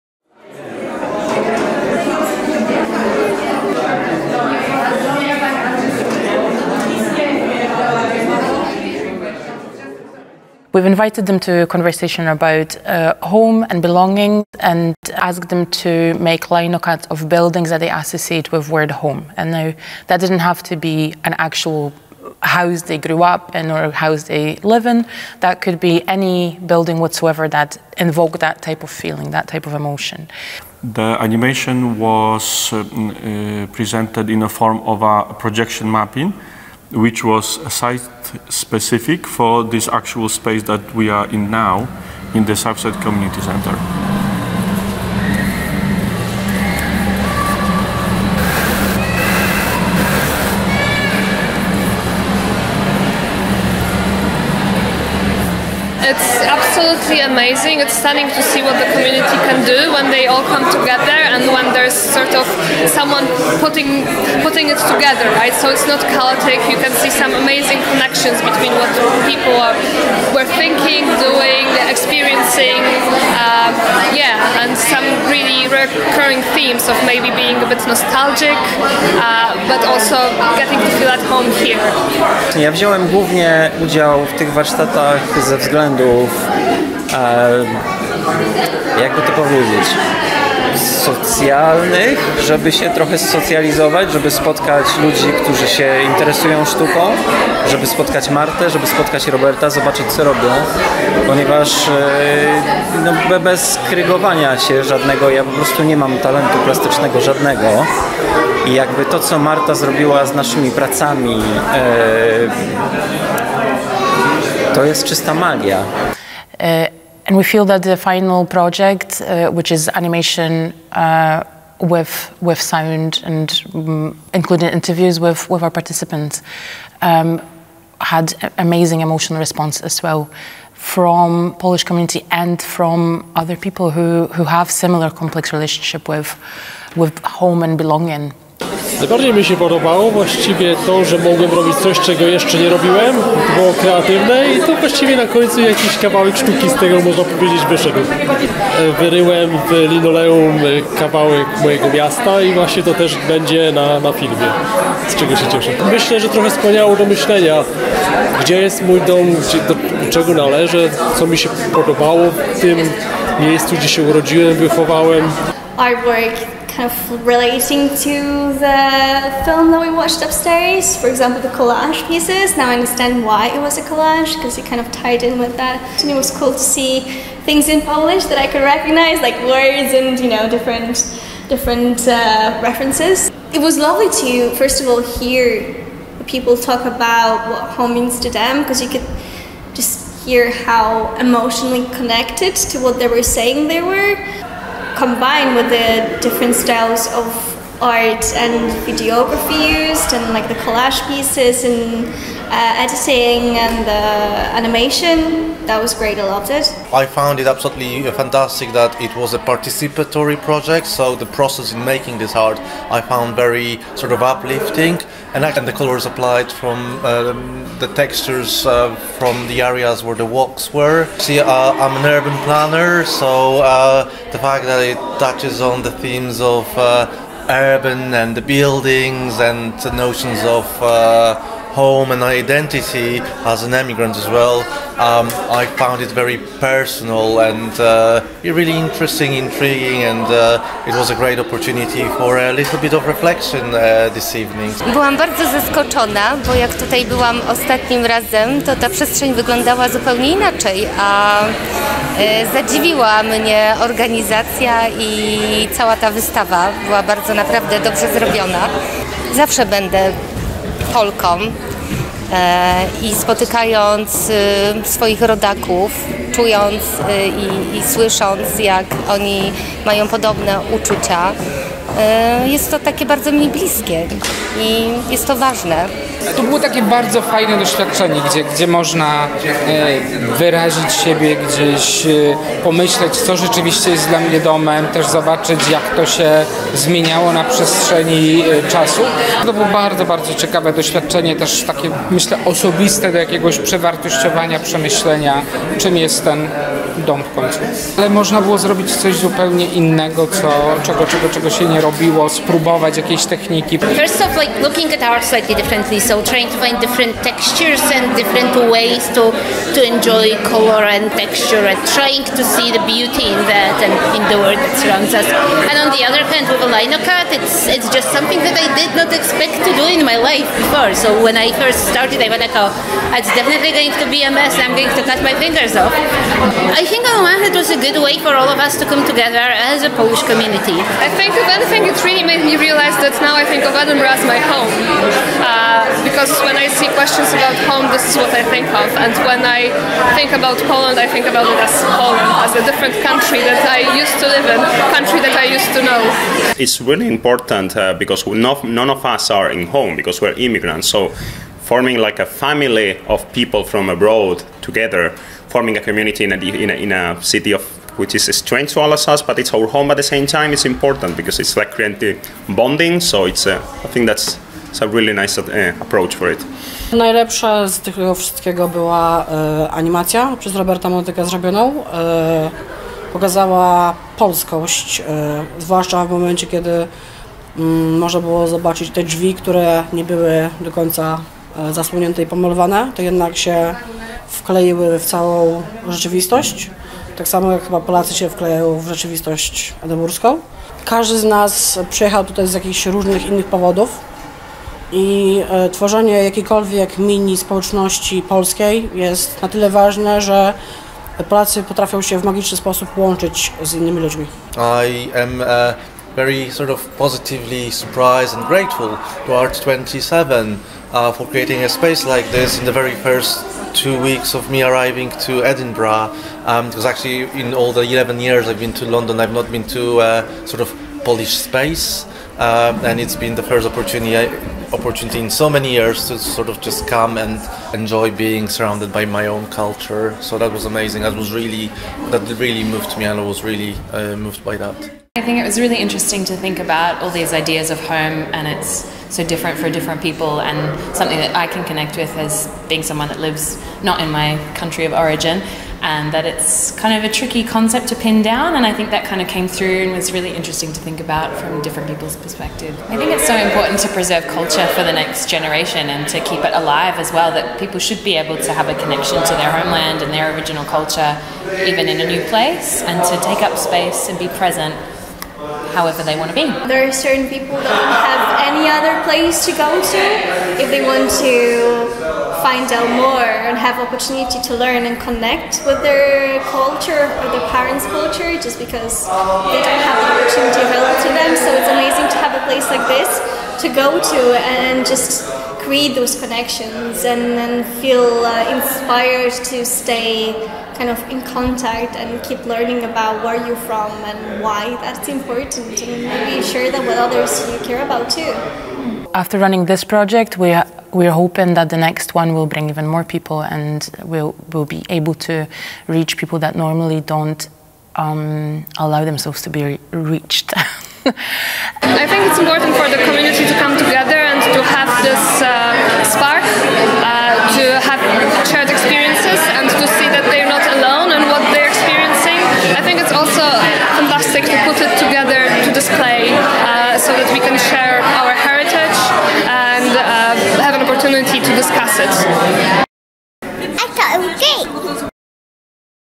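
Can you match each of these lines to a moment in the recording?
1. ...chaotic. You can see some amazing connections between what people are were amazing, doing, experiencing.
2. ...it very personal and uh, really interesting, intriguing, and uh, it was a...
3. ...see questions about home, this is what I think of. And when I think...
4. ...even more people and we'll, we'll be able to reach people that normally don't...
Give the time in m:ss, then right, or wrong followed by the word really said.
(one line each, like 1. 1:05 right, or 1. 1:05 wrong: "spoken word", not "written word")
1. 1:06 wrong: "thinking", not "amazing"
2. 3:56 right
3. 5:36 right
4. 8:22 right.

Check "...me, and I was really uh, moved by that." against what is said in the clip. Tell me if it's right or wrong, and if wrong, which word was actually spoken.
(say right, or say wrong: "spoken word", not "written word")
right.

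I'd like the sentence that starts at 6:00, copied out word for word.
It's important because it's like creative bonding.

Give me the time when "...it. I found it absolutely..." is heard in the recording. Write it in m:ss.
3:26.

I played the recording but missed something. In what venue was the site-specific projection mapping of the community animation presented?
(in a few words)
Southside community center.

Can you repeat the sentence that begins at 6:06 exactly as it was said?
Najlepsza z tego wszystkiego była e, animacja przez Roberta Motyka zrobioną.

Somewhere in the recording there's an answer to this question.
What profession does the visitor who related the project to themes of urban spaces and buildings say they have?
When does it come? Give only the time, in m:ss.
3:42.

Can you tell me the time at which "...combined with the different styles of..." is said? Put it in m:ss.
3:15.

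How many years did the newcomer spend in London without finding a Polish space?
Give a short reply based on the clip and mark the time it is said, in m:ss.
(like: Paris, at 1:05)
11, at 6:57.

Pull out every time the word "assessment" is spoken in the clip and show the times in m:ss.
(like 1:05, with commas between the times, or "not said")
not said.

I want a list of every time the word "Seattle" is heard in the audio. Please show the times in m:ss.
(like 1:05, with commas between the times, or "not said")
not said.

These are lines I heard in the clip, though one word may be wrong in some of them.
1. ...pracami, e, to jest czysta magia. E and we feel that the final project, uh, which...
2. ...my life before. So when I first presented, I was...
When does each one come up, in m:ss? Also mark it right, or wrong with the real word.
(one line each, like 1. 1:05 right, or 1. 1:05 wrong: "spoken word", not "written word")
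1. 1:50 right
2. 5:20 wrong: "started", not "presented".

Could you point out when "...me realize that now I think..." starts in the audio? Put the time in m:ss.
5:32.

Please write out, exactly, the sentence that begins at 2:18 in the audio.
Najbardziej mi się podobało właściwie to, że mogłem robić coś, czego jeszcze nie robiłem.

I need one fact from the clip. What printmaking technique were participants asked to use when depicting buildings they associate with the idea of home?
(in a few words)
lino cuts.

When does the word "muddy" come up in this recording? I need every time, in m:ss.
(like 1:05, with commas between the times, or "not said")
not said.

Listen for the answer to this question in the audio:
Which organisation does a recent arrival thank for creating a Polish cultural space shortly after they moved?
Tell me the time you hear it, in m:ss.
6:49.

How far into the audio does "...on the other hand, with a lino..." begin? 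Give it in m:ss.
5:15.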